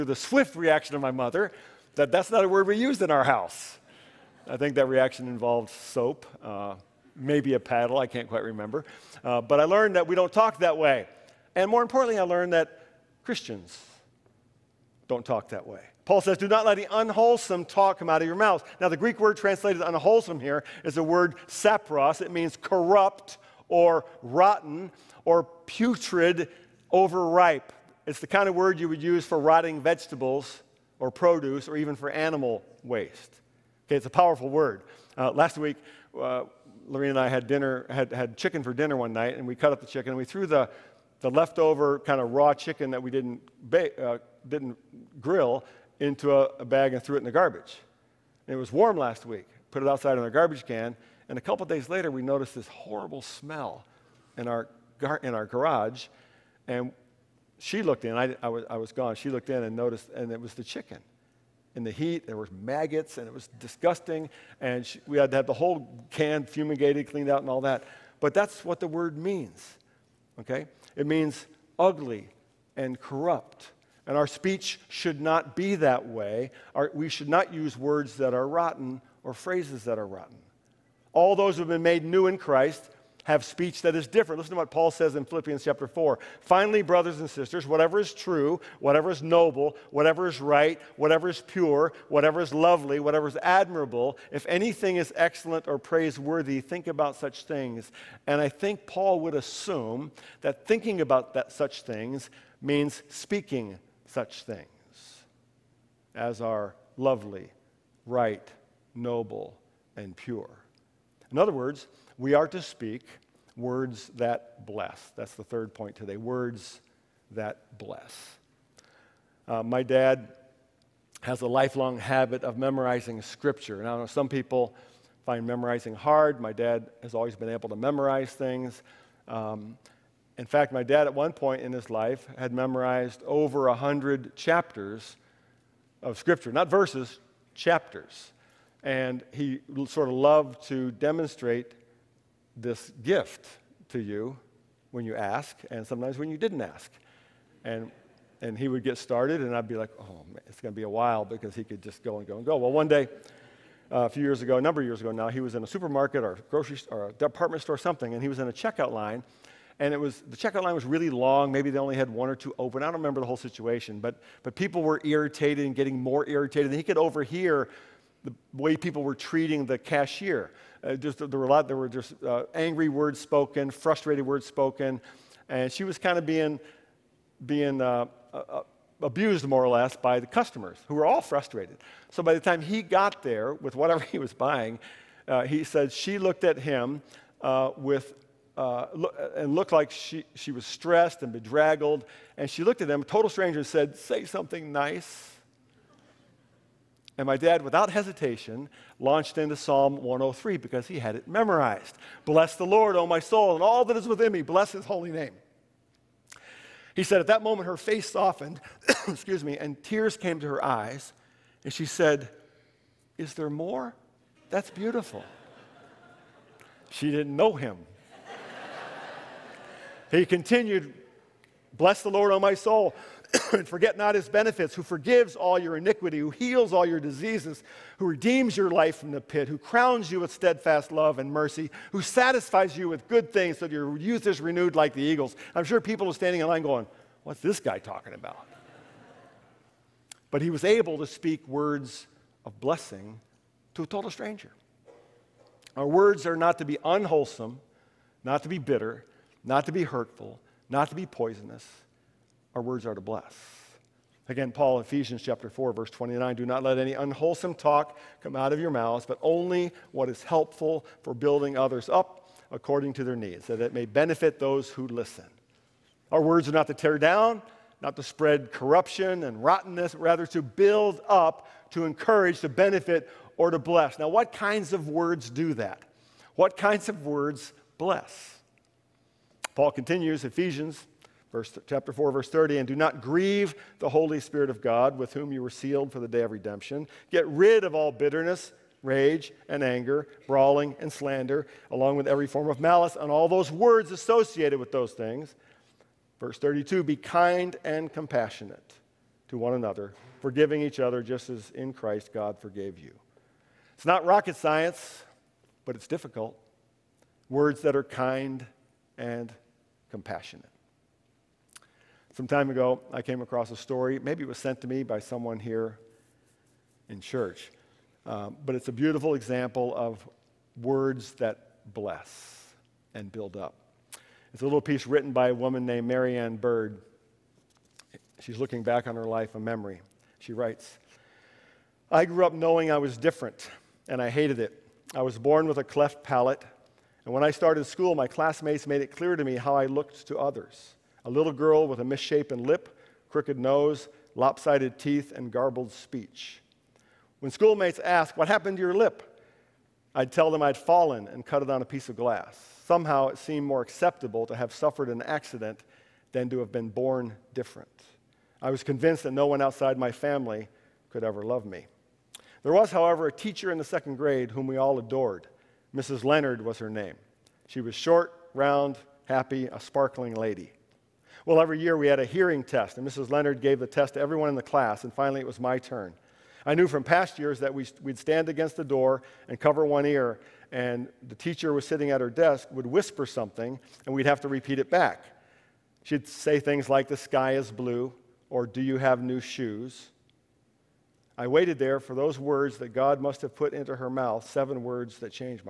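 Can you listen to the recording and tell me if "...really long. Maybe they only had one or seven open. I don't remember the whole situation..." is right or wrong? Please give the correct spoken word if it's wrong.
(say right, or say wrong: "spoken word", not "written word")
wrong: "two", not "seven".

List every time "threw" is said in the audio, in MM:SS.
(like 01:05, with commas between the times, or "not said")
00:40, 00:47.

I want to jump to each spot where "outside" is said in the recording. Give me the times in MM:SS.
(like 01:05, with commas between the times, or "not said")
00:49, 05:59.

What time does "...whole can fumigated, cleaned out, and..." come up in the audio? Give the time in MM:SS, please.
01:05.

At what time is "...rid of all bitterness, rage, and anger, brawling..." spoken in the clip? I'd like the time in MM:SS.
04:47.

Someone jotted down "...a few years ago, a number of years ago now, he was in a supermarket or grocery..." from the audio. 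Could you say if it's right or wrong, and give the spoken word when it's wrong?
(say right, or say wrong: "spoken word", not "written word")
right.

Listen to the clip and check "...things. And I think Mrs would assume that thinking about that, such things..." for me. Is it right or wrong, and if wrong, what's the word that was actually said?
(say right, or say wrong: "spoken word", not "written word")
wrong: "Paul", not "Mrs".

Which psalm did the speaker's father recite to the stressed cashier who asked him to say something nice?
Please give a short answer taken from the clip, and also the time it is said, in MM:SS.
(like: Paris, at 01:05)
Psalm 103, at 03:19.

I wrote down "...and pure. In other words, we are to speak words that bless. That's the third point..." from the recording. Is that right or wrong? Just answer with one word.
right.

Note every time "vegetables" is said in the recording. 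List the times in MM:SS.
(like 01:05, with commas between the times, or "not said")
00:29.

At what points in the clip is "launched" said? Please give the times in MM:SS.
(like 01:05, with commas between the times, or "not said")
03:18.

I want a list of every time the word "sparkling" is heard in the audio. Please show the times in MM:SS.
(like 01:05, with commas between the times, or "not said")
06:09.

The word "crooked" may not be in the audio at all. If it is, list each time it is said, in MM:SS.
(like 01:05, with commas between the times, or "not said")
05:43.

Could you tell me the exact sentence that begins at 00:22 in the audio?
It means corrupt or rotten or putrid, overripe.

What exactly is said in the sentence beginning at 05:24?
It's a little piece written by a woman named Mary Ann Bird.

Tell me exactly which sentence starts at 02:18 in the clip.
And he sort of loved to demonstrate this gift to you when you ask and sometimes when you didn't ask.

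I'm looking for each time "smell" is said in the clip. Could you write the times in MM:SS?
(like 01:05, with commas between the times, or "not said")
00:53.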